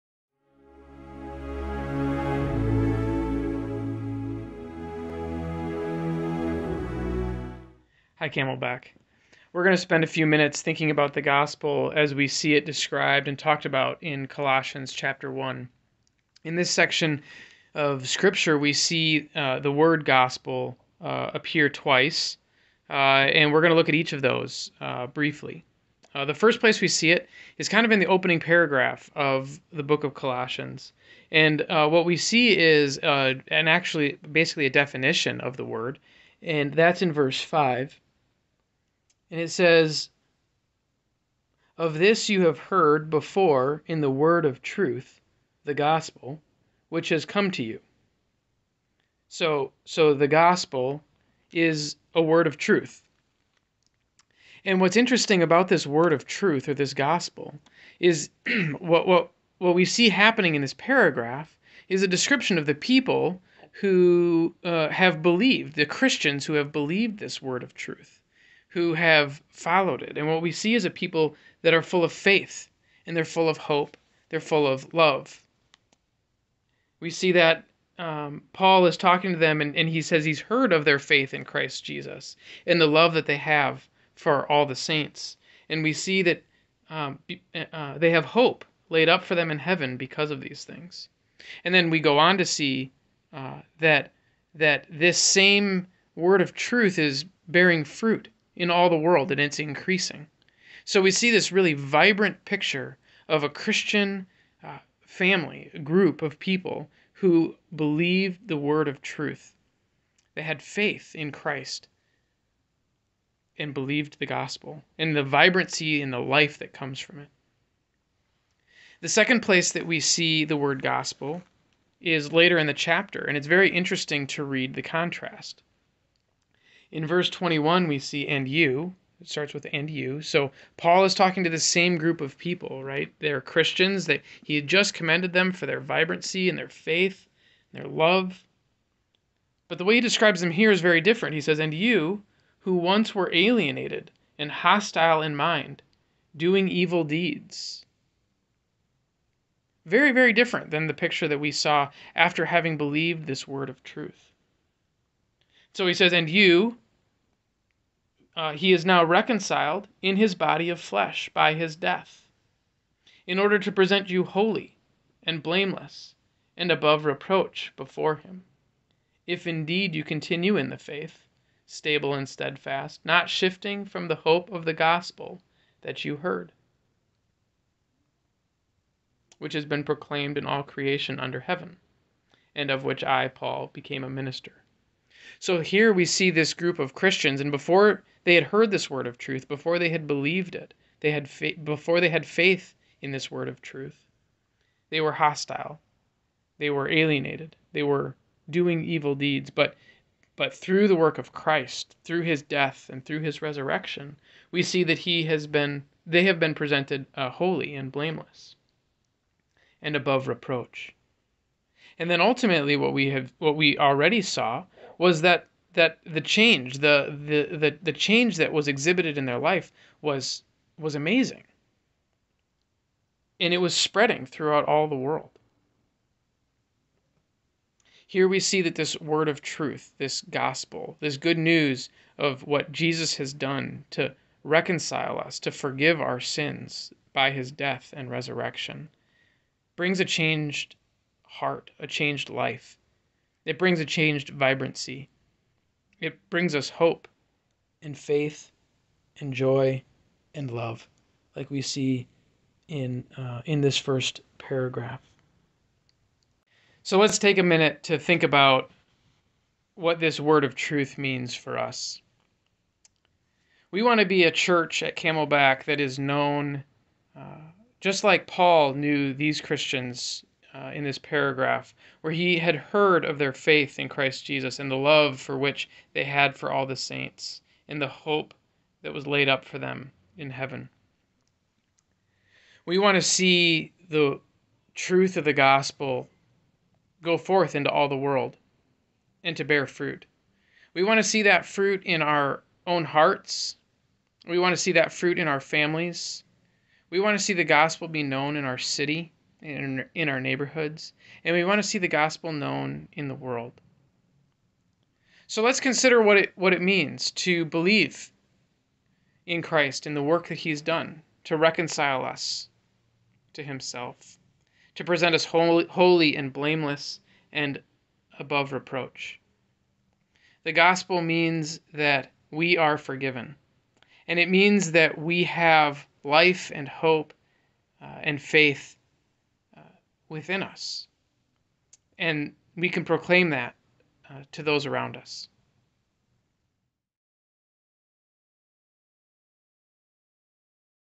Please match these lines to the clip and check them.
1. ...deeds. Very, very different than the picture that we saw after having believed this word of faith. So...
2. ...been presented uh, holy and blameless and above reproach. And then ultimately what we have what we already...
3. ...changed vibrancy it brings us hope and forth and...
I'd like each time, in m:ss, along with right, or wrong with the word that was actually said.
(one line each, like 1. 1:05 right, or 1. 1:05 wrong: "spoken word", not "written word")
1. 2:27 wrong: "truth", not "faith"
2. 3:26 right
3. 4:03 wrong: "faith", not "forth".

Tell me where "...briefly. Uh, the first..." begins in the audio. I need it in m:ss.
0:25.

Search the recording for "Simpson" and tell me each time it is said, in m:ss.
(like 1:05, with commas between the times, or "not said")
not said.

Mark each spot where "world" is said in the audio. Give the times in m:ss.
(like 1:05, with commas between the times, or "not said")
1:38, 3:44, 4:47, 5:03.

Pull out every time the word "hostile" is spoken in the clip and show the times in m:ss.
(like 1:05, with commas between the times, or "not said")
2:24, 3:15.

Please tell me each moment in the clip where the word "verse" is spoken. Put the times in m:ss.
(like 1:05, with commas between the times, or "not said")
0:37, 2:07.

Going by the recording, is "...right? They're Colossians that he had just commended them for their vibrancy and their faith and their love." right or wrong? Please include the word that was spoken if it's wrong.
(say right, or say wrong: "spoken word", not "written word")
wrong: "Christians", not "Colossians".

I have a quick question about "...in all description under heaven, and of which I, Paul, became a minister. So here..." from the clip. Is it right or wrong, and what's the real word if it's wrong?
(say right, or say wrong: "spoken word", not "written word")
wrong: "creation", not "description".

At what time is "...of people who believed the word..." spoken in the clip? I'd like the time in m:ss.
1:46.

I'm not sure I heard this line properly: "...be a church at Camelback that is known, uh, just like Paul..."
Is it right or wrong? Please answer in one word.
right.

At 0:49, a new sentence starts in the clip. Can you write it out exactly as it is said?
So, so the gospel is a word of truth.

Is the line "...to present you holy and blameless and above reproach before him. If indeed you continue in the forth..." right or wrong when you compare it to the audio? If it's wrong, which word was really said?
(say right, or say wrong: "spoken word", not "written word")
wrong: "faith", not "forth".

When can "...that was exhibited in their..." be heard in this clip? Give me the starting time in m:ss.
3:38.